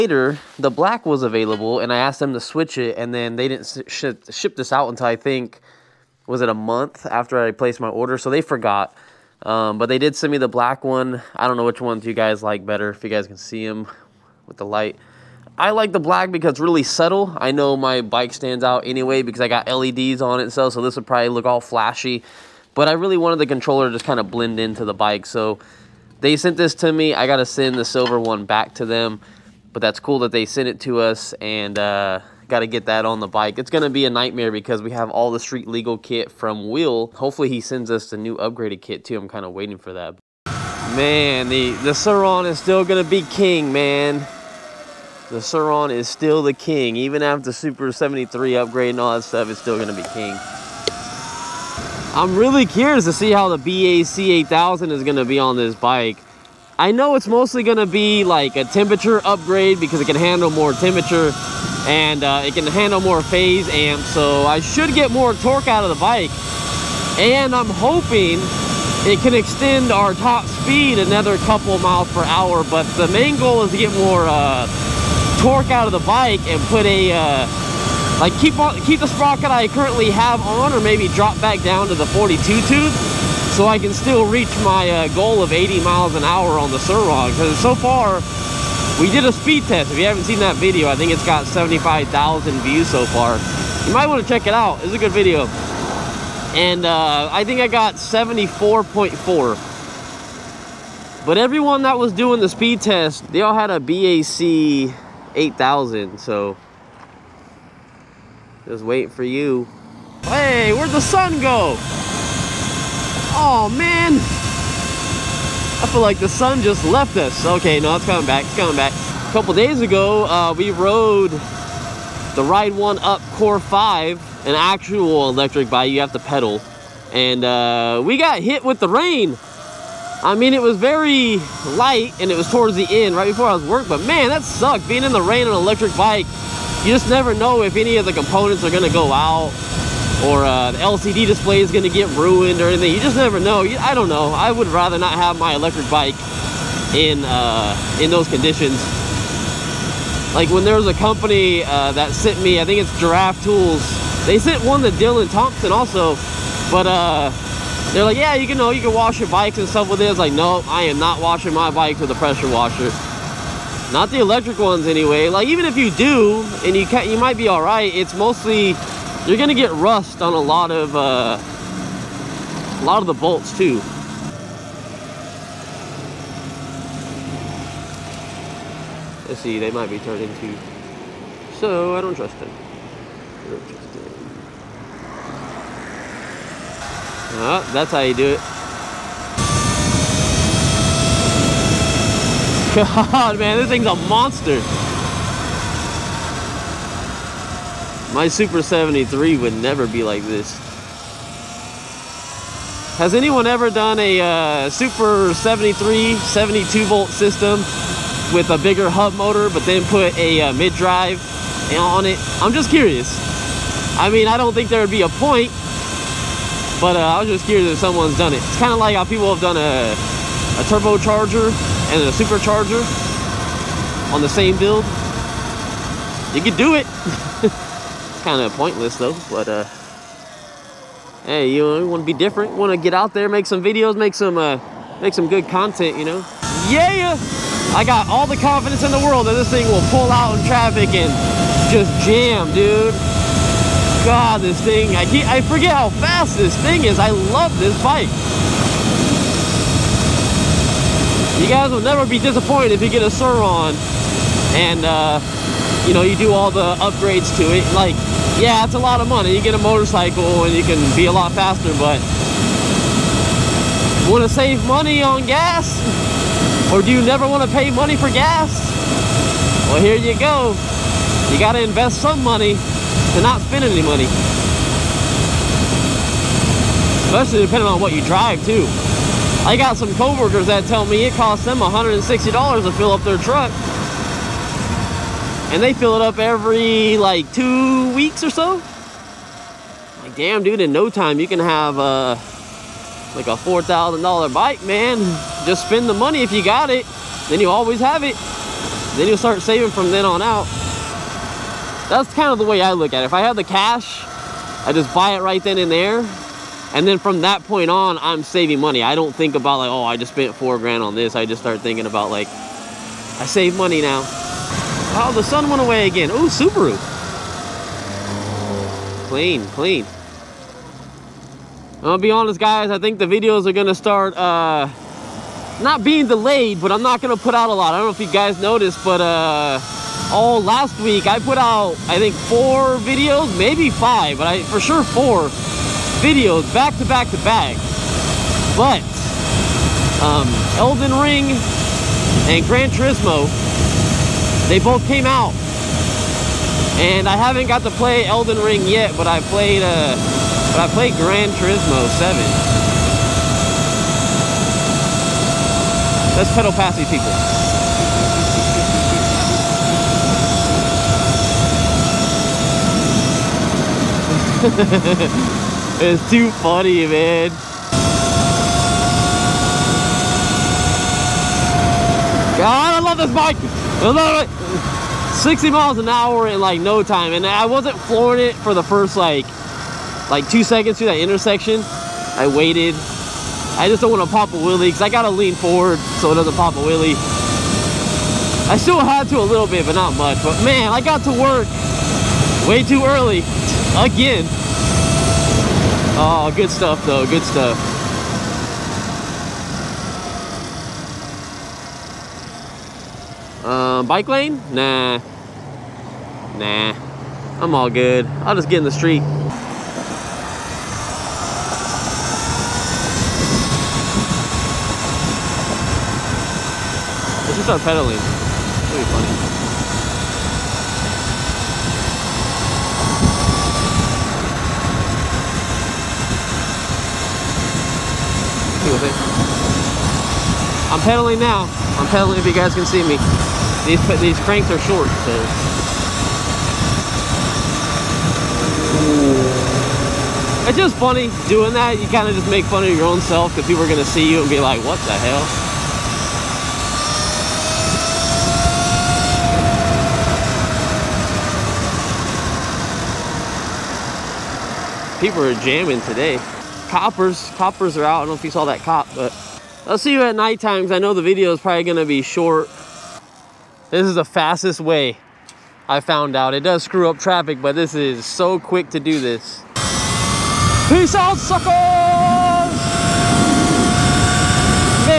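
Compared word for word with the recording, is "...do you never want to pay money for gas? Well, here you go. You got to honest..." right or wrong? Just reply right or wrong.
wrong.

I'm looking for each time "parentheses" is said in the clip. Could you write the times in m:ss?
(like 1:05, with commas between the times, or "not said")
not said.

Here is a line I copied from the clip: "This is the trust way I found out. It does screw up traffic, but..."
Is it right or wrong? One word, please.
wrong.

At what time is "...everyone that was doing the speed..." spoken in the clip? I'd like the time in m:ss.
1:41.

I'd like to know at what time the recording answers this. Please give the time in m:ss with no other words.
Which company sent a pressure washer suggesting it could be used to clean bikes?
2:32.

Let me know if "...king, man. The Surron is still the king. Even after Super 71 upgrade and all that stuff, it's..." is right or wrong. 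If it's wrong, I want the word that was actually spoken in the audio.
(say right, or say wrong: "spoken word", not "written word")
wrong: "73", not "71".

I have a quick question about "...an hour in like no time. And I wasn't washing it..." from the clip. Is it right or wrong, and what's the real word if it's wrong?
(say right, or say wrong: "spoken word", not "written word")
wrong: "flooring", not "washing".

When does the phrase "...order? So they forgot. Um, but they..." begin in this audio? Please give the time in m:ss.
0:07.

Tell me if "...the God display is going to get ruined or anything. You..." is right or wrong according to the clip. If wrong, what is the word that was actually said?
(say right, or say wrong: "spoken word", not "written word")
wrong: "LCD", not "God".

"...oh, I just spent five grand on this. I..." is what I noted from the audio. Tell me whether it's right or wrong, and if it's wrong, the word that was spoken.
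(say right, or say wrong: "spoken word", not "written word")
wrong: "four", not "five".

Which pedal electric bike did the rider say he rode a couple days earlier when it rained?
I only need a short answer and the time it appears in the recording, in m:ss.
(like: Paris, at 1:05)
Ride 1 Up Core 5, at 2:02.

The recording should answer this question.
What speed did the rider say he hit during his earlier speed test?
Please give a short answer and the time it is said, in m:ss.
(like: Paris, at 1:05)
74.4, at 1:37.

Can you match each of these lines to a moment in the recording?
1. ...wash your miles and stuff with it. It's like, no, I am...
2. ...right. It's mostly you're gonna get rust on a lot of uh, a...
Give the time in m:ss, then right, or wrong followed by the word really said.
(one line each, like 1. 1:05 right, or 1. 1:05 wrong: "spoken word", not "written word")
1. 2:38 wrong: "bikes", not "miles"
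2. 2:47 right.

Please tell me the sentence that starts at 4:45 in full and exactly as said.
And they fill it up every like two weeks or so.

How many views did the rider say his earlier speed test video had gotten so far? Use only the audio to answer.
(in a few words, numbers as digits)
75,000.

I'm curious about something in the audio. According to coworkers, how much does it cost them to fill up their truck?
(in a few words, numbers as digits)
$160.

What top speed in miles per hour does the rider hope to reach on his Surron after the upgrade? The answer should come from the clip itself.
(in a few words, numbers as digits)
80.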